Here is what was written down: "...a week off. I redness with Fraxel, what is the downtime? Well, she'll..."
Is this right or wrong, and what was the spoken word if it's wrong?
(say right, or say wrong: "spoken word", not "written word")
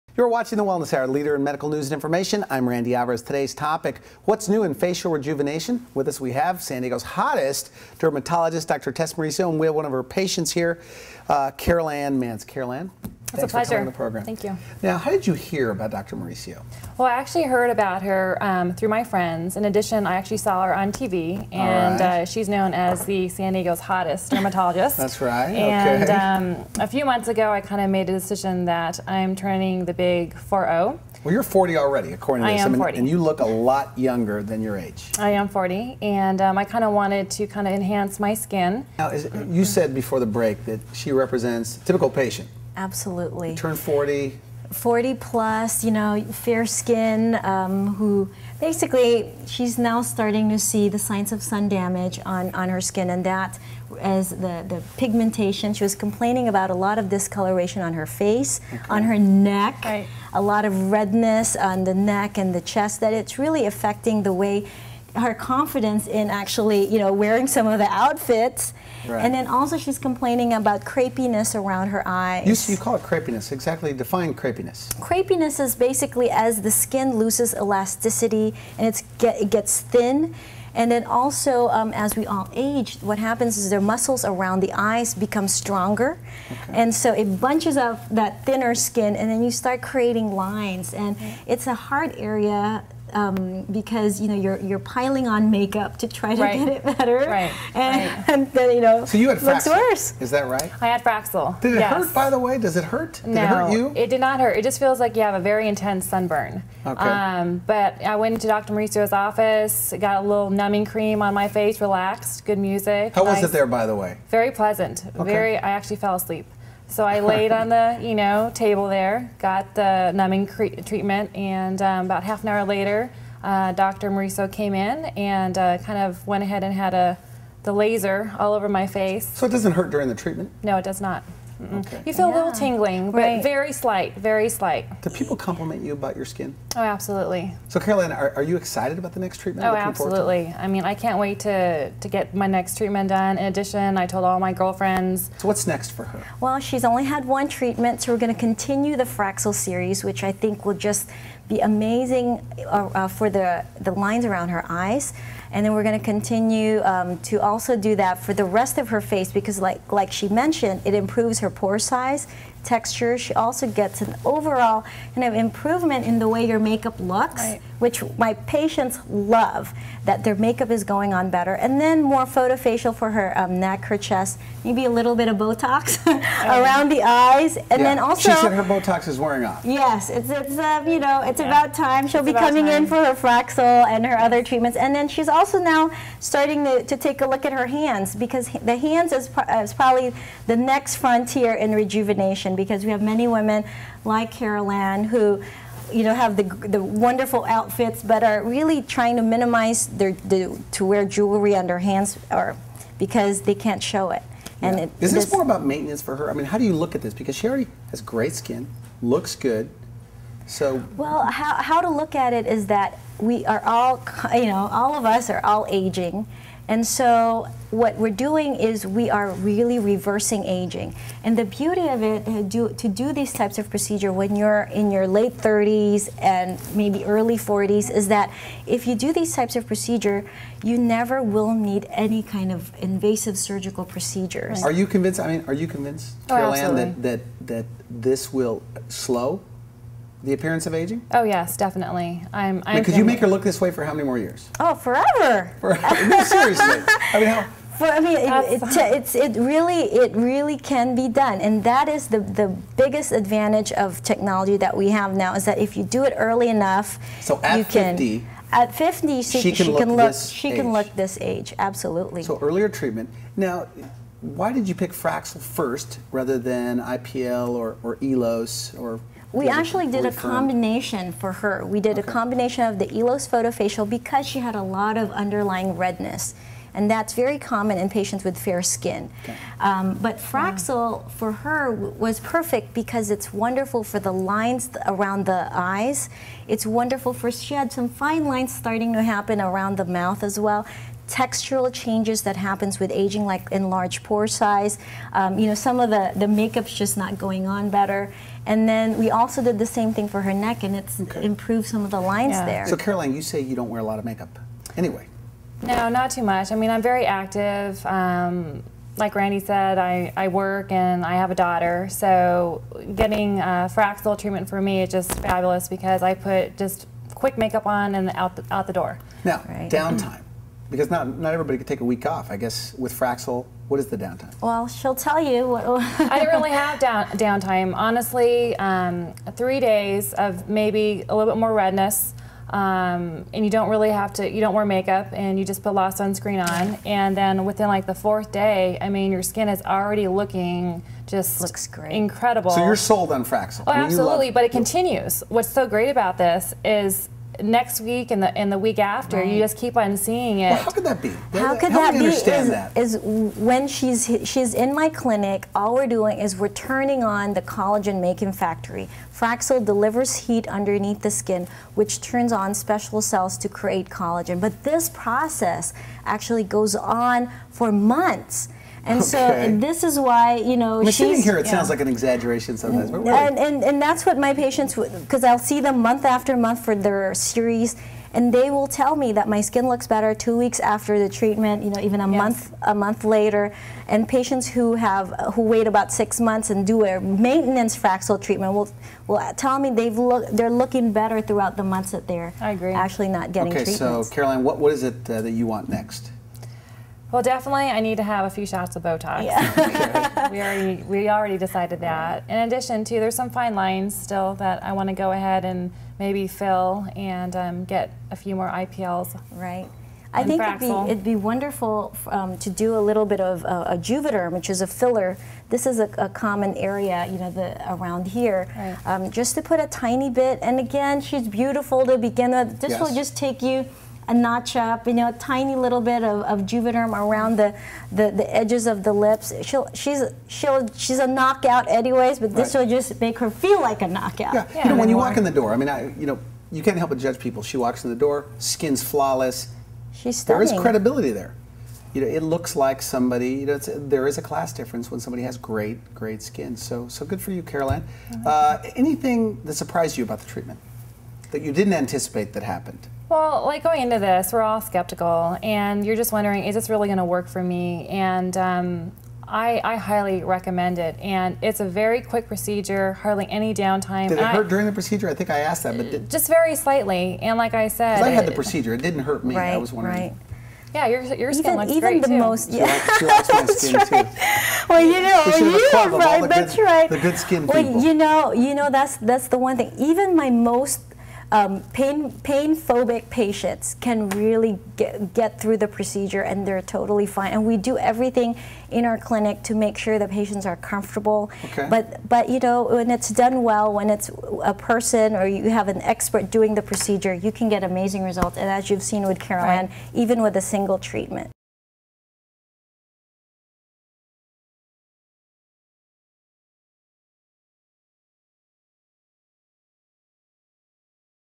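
wrong: "guess", not "redness".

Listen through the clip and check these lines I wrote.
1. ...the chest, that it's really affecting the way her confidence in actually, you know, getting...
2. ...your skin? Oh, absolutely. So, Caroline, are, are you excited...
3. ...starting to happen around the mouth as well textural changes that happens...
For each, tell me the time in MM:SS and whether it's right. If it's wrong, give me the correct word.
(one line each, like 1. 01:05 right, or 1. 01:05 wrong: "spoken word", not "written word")
1. 01:02 wrong: "wearing", not "getting"
2. 02:16 right
3. 04:48 right.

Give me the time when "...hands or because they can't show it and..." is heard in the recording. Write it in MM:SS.
03:21.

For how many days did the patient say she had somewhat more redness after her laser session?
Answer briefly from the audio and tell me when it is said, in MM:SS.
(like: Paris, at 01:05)
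3, at 05:29.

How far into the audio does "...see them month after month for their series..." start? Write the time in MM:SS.
06:15.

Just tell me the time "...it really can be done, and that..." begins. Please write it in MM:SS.
04:09.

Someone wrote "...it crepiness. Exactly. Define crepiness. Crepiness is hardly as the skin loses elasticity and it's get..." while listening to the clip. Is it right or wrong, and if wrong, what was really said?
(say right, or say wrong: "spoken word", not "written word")
wrong: "basically", not "hardly".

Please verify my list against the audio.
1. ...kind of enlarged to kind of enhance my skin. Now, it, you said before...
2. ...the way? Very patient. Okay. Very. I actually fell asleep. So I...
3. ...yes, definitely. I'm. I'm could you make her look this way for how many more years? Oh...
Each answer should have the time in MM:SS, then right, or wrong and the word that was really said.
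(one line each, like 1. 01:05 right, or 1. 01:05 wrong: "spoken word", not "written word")
1. 00:36 wrong: "wanted", not "enlarged"
2. 01:53 wrong: "pleasant", not "patient"
3. 04:01 right.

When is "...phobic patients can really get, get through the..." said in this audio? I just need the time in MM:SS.
08:02.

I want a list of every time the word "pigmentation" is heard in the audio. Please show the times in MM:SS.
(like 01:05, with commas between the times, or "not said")
00:54.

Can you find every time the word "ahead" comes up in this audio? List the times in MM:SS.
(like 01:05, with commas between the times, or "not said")
02:06, 06:45.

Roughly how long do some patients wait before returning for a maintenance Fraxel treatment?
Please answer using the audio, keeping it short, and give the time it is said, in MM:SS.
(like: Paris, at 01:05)
6 months, at 06:25.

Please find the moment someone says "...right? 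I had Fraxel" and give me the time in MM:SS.
01:40.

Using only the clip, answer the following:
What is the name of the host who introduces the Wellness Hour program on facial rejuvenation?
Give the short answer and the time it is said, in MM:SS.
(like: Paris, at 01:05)
Randy Alvarez, at 00:02.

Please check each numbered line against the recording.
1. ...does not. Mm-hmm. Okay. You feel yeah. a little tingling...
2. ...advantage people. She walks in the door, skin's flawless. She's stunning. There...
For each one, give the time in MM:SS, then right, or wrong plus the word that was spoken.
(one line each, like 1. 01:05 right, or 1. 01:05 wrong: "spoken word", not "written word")
1. 02:10 right
2. 07:16 wrong: "judge", not "advantage".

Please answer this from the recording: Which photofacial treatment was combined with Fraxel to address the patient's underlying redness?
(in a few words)
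ELOS photofacial.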